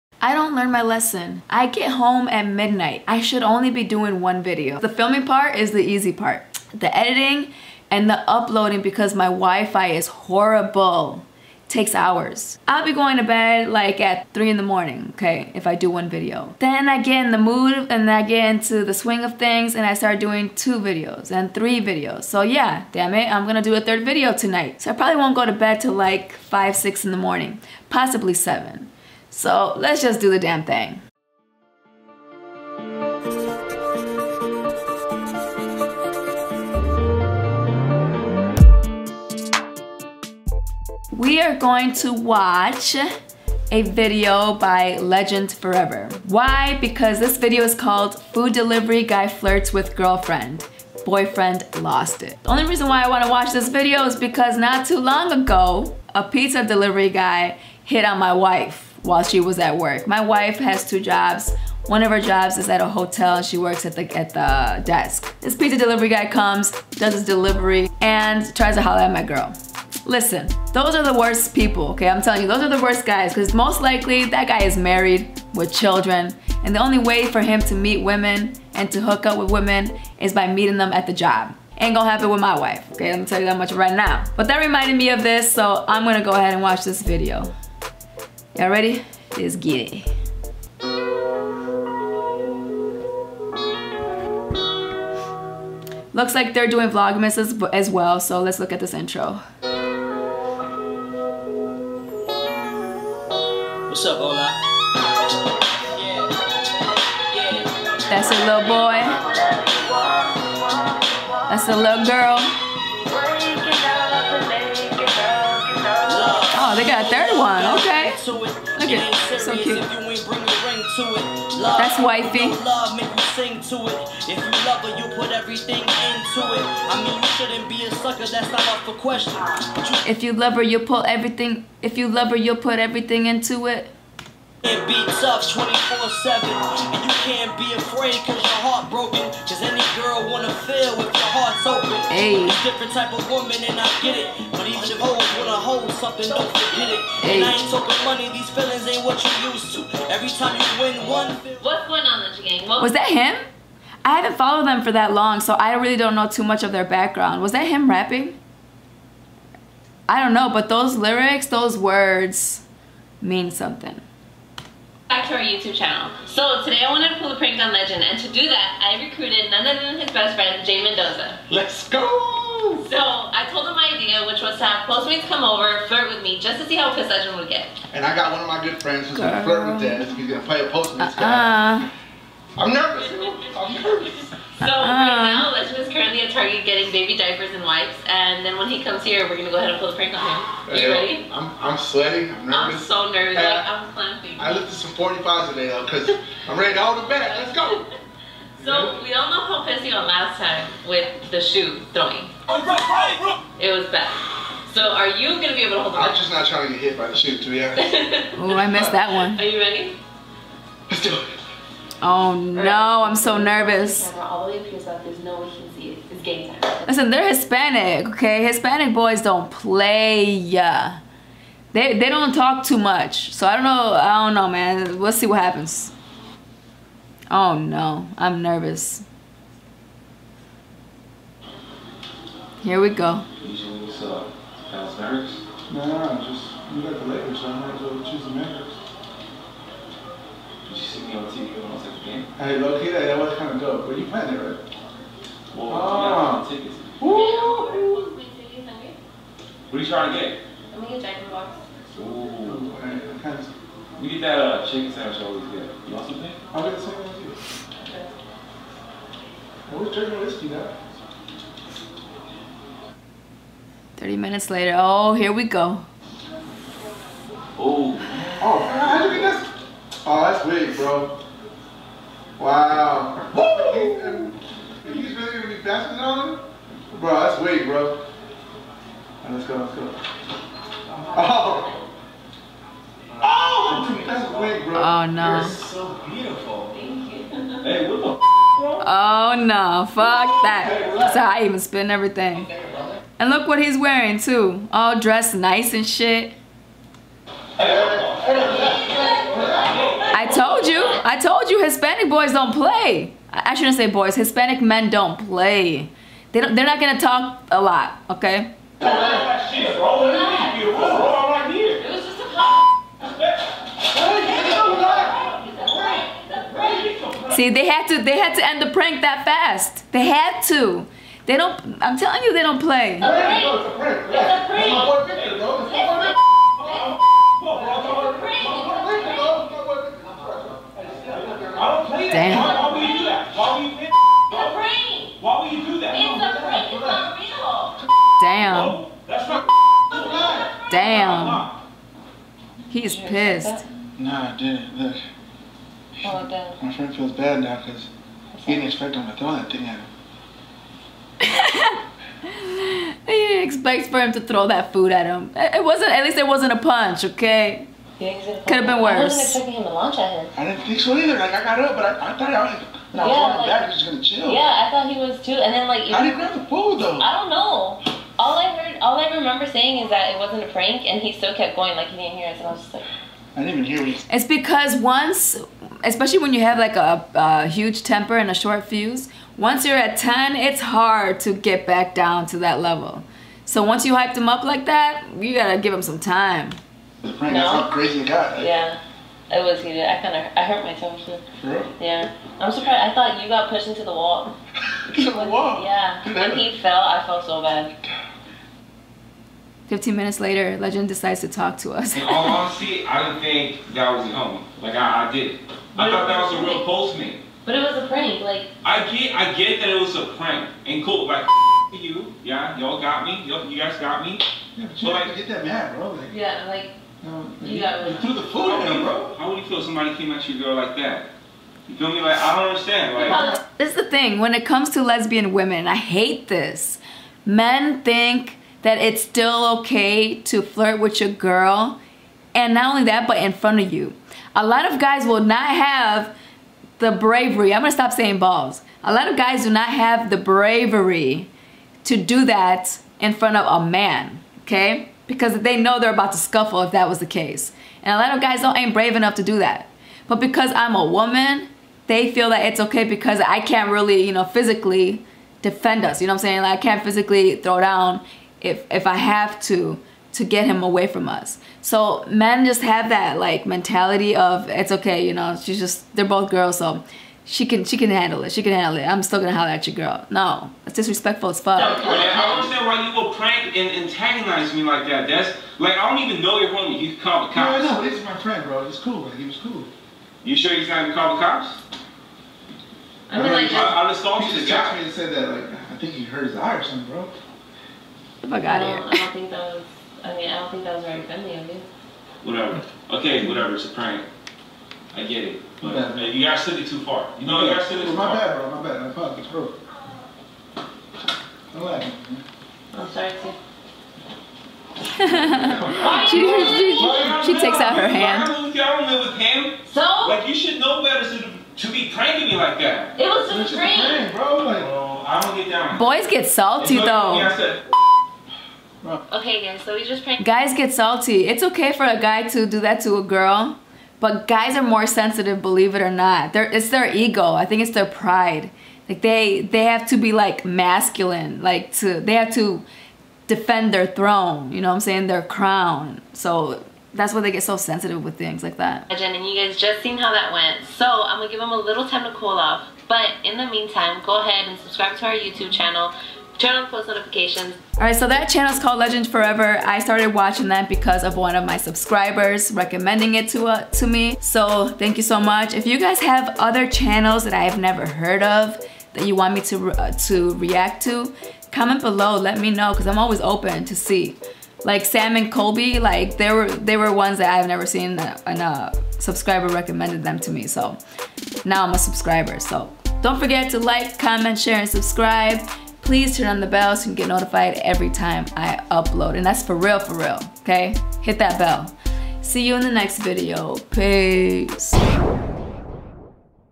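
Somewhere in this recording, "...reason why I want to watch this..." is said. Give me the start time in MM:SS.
00:52.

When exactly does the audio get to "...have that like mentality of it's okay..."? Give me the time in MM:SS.
07:42.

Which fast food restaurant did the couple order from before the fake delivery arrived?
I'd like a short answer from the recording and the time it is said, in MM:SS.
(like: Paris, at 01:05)
Jack in the Box, at 04:11.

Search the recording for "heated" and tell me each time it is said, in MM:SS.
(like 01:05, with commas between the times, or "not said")
06:29.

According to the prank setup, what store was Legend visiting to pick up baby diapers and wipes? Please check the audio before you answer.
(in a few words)
Target.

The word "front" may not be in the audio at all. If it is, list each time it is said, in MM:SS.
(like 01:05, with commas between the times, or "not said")
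07:13, 07:23.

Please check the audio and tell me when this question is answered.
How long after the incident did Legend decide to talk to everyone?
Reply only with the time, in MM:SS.
06:39.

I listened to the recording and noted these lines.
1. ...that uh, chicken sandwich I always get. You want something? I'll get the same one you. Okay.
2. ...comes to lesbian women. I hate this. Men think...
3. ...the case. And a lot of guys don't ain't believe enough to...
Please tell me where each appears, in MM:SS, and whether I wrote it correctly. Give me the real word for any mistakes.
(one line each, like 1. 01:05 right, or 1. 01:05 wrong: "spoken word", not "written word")
1. 04:14 right
2. 07:04 right
3. 07:26 wrong: "brave", not "believe".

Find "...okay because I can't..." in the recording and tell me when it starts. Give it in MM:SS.
07:32.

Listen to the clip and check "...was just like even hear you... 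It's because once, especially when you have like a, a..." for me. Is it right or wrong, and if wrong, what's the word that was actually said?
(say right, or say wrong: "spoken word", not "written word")
right.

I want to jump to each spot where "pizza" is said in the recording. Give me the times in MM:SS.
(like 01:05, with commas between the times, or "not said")
00:56, 01:05.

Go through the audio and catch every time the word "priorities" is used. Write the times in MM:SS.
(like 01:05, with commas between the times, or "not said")
not said.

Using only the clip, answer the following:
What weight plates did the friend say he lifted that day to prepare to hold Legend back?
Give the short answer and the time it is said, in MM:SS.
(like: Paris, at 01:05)
45s, at 03:14.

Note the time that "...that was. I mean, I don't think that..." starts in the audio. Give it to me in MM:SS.
08:09.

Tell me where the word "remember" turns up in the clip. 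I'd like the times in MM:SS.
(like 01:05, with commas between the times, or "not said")
06:09.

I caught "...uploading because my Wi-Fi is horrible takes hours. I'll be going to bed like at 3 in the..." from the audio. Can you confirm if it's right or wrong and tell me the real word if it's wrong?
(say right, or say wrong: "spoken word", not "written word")
right.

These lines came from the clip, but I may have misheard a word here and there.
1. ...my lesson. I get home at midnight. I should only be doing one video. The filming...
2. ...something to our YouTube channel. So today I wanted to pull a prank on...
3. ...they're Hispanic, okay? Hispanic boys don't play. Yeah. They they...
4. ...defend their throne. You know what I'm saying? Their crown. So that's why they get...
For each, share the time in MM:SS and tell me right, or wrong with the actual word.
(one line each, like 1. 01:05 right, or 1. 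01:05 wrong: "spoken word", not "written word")
1. 00:00 right
2. 02:43 right
3. 03:37 right
4. 08:53 right.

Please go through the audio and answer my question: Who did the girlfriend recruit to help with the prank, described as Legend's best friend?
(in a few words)
Jay Mendoza.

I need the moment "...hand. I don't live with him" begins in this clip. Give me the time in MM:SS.
08:27.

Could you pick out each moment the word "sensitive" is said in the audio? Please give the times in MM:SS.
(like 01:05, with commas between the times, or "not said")
08:44, 08:57.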